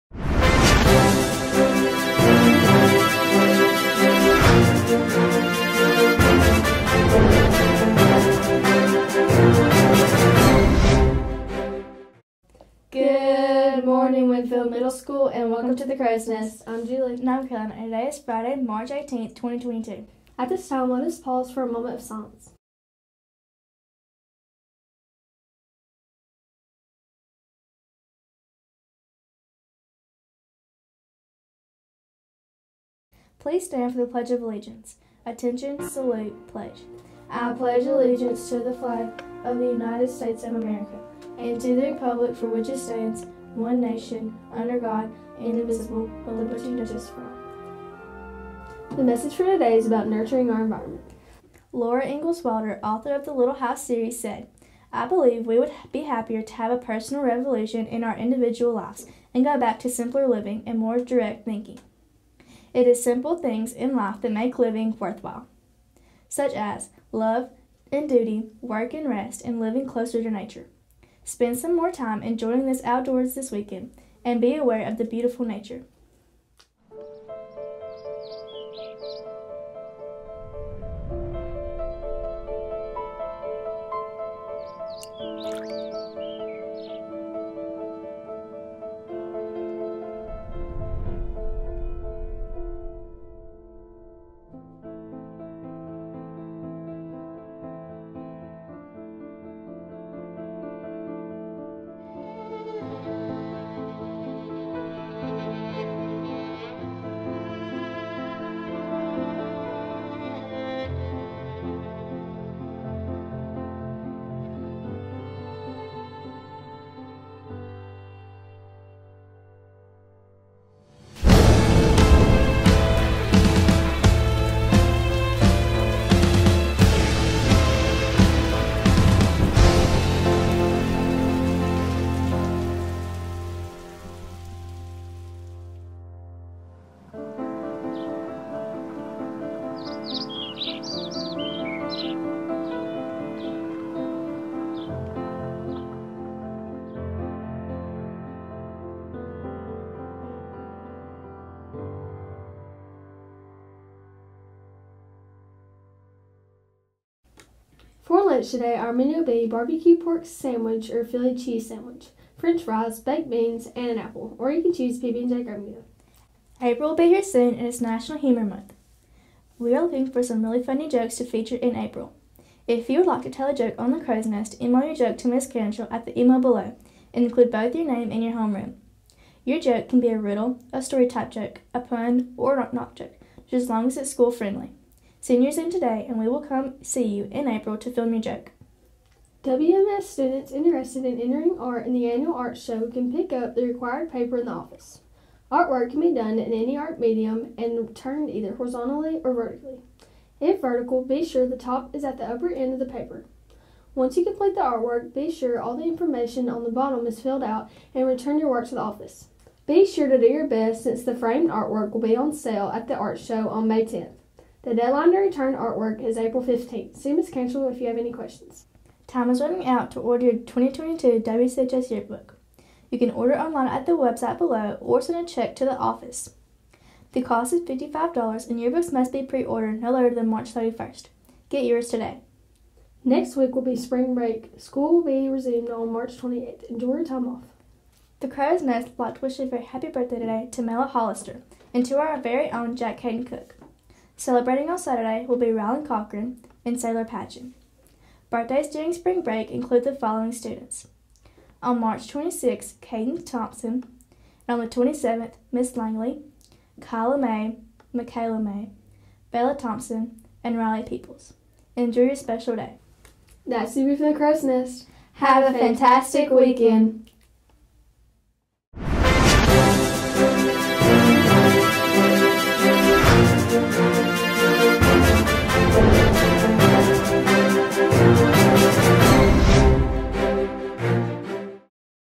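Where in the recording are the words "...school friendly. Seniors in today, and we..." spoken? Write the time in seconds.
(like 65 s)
184 s.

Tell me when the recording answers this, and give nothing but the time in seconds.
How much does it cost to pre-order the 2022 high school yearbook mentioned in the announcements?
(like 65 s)
227 s.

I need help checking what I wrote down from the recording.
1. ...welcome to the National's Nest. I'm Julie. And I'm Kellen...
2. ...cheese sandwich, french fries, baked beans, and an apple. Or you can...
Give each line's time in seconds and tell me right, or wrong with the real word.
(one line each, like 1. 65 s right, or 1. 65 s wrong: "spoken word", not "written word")
1. 15 s wrong: "Crow", not "National"
2. 161 s right.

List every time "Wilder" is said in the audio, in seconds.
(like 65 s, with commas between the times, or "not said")
52 s.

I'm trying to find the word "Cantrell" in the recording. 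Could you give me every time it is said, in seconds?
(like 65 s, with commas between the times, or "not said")
175 s, 217 s.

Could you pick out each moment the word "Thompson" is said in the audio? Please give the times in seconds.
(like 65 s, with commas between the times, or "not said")
253 s, 259 s.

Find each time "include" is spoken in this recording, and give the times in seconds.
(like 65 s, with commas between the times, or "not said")
177 s, 249 s.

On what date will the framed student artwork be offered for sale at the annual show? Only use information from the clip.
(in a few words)
May 10th.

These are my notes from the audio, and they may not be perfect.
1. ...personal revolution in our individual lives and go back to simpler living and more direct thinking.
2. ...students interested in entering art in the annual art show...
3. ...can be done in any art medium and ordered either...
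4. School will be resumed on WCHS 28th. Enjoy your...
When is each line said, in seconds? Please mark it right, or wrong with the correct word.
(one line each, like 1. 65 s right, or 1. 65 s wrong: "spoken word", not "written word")
1. 56 s right
2. 190 s right
3. 195 s wrong: "turned", not "ordered"
4. 234 s wrong: "March", not "WCHS".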